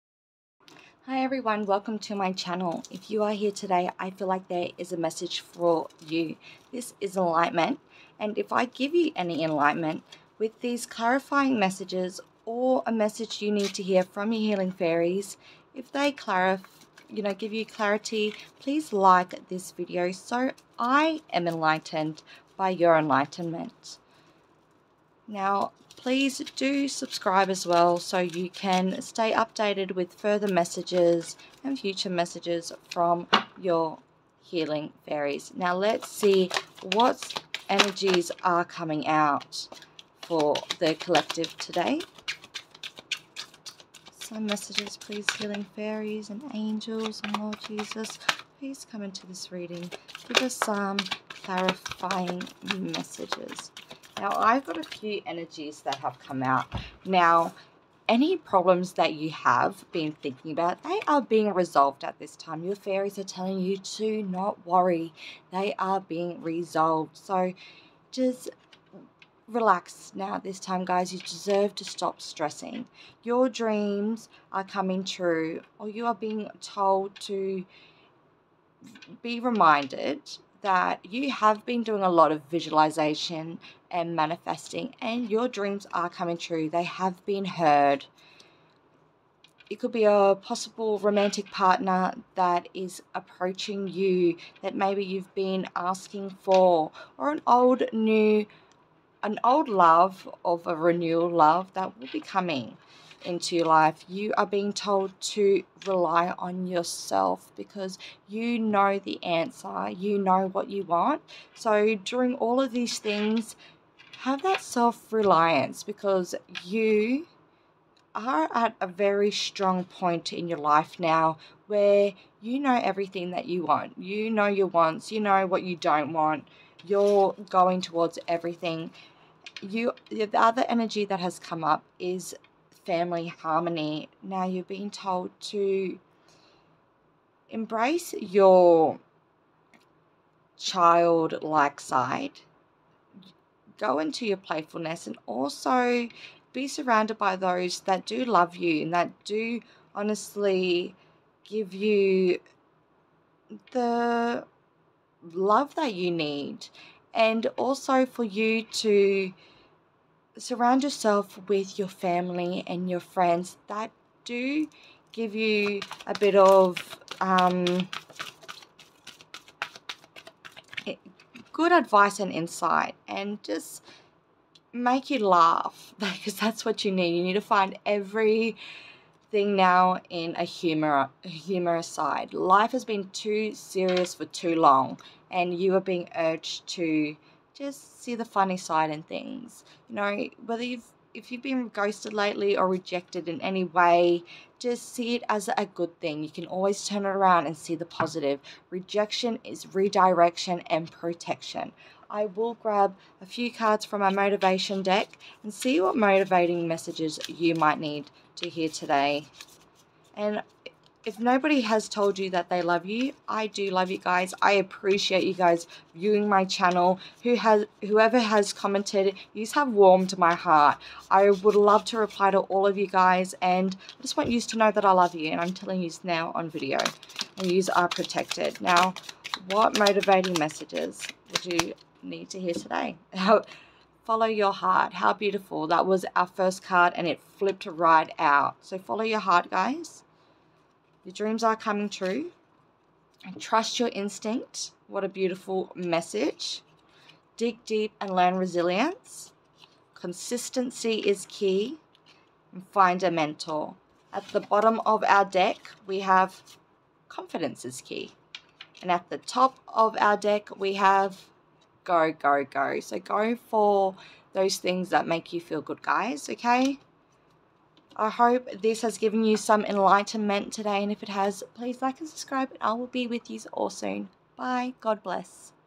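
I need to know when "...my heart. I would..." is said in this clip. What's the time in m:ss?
3:40.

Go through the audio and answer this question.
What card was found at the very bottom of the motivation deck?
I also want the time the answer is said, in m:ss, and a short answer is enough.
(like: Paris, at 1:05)
Confidence is key, at 4:17.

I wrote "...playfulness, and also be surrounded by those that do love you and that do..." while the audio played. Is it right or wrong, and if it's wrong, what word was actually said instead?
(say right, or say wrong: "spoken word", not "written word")
right.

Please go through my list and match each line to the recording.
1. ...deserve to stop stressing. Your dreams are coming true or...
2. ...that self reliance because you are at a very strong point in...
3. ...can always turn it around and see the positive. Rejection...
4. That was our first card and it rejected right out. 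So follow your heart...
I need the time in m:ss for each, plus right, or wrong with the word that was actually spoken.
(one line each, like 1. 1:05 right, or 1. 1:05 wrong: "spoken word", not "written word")
1. 1:11 right
2. 1:54 right
3. 3:16 right
4. 3:55 wrong: "flipped", not "rejected".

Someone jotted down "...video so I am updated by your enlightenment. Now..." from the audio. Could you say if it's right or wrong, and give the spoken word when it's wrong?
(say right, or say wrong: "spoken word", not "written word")
wrong: "enlightened", not "updated".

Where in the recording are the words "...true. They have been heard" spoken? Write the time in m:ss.
1:26.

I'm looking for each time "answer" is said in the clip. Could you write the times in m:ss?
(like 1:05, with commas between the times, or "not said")
1:49.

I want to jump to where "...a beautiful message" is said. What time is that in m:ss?
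4:05.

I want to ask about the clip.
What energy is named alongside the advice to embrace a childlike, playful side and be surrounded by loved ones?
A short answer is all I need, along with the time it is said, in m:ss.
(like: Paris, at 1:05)
Family harmony, at 2:12.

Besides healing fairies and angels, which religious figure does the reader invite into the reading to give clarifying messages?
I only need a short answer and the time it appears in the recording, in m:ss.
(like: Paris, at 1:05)
Lord Jesus, at 0:47.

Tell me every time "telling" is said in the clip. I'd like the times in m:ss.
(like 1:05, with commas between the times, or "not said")
1:03, 3:45.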